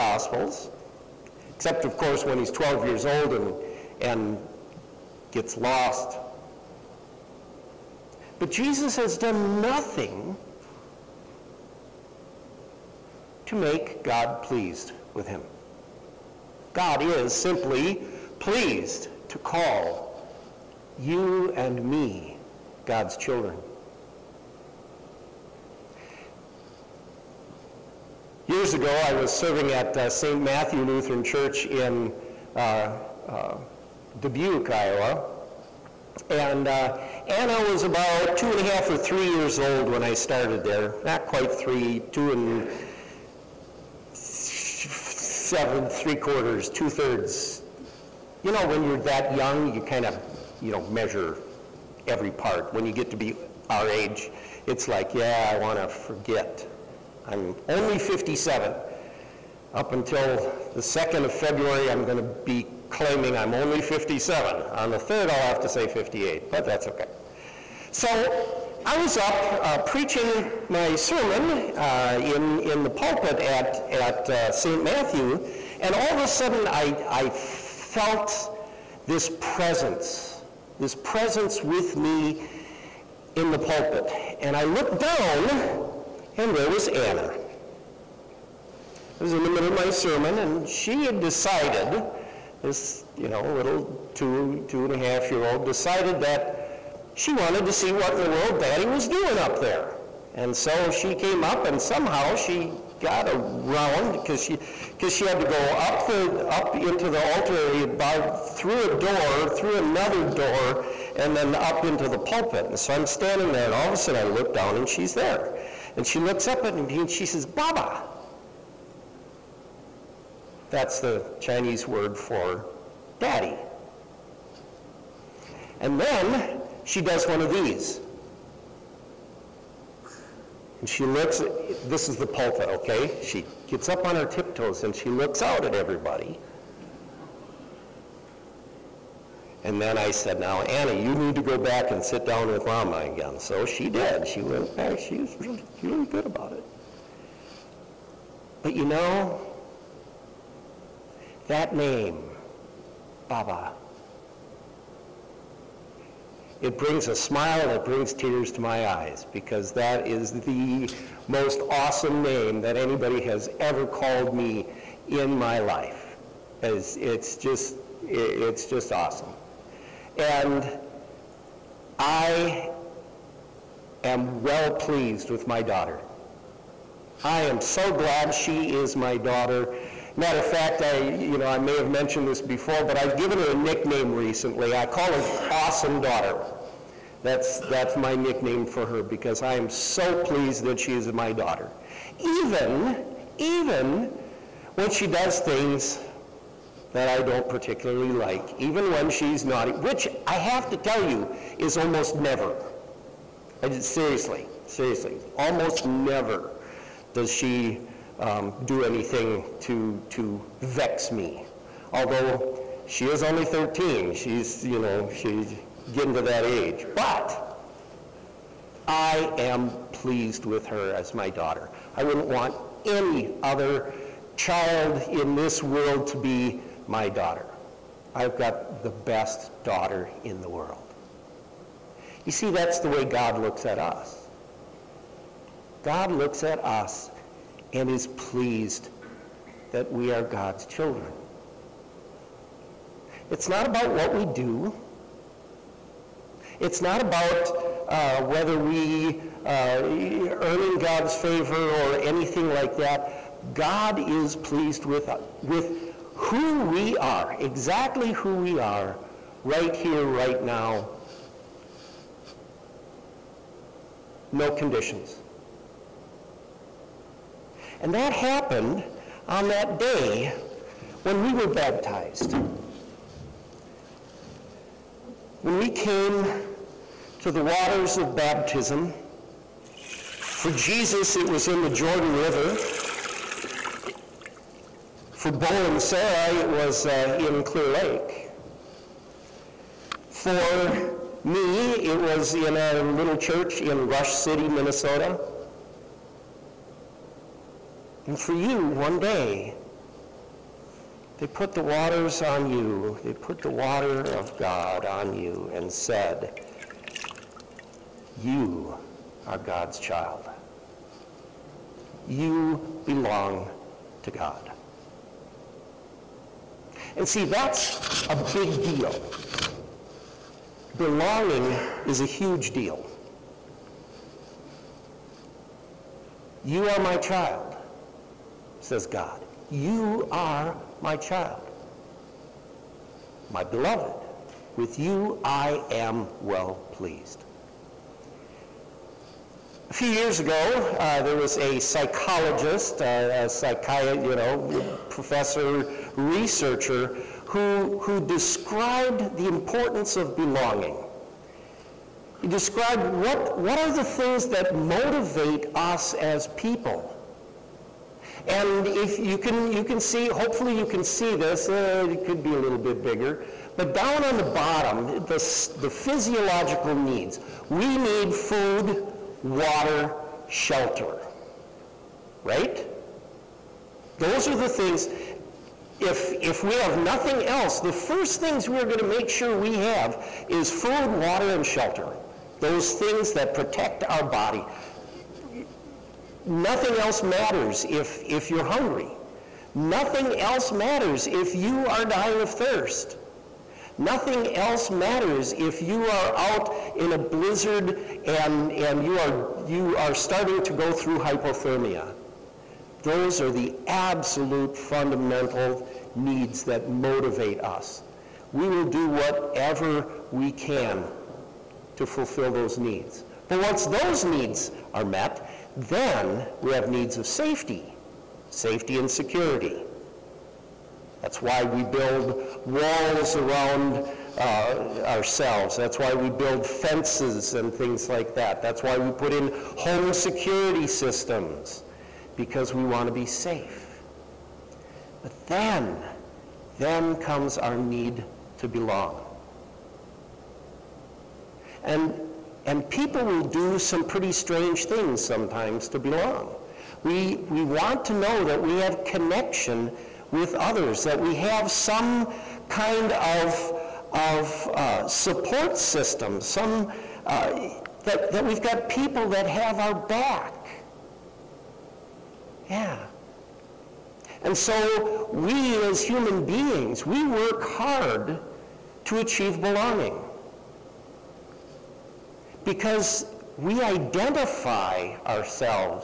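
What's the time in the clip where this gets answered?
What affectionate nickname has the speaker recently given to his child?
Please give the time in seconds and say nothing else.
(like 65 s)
185 s.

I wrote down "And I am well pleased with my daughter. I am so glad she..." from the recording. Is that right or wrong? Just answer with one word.
right.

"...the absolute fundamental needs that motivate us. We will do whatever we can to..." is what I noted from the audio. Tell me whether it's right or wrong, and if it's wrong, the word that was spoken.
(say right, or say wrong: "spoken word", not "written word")
right.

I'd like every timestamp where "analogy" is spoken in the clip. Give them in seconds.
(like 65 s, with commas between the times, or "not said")
not said.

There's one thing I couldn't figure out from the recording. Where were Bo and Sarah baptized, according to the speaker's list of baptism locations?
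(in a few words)
Clear Lake.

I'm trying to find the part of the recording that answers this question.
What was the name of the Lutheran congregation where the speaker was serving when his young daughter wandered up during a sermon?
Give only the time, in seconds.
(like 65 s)
30 s.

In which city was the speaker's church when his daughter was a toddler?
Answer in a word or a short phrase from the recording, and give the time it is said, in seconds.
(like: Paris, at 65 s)
Dubuque, Iowa, at 34 s.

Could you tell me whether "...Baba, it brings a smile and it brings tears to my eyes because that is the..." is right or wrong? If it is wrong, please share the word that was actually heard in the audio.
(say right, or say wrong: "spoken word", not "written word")
right.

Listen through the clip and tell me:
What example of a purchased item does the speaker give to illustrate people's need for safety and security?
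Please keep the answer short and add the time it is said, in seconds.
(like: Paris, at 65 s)
home security systems, at 429 s.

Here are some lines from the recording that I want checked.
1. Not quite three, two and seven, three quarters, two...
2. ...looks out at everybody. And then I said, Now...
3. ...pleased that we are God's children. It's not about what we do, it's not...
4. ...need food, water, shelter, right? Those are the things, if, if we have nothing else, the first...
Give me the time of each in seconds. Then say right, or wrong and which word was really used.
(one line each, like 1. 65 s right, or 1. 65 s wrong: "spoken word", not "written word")
1. 41 s right
2. 135 s right
3. 238 s right
4. 367 s right.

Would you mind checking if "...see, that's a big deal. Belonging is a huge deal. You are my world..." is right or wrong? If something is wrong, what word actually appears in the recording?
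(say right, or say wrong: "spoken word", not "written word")
wrong: "child", not "world".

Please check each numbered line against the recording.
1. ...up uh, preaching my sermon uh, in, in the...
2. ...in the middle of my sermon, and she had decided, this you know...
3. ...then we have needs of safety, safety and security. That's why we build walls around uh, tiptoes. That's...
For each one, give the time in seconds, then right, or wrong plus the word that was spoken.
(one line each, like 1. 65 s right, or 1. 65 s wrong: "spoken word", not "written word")
1. 69 s right
2. 89 s right
3. 415 s wrong: "ourselves", not "tiptoes".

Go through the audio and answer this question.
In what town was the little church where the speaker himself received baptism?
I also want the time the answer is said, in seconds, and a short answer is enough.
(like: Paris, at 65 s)
Rush City, Minnesota, at 293 s.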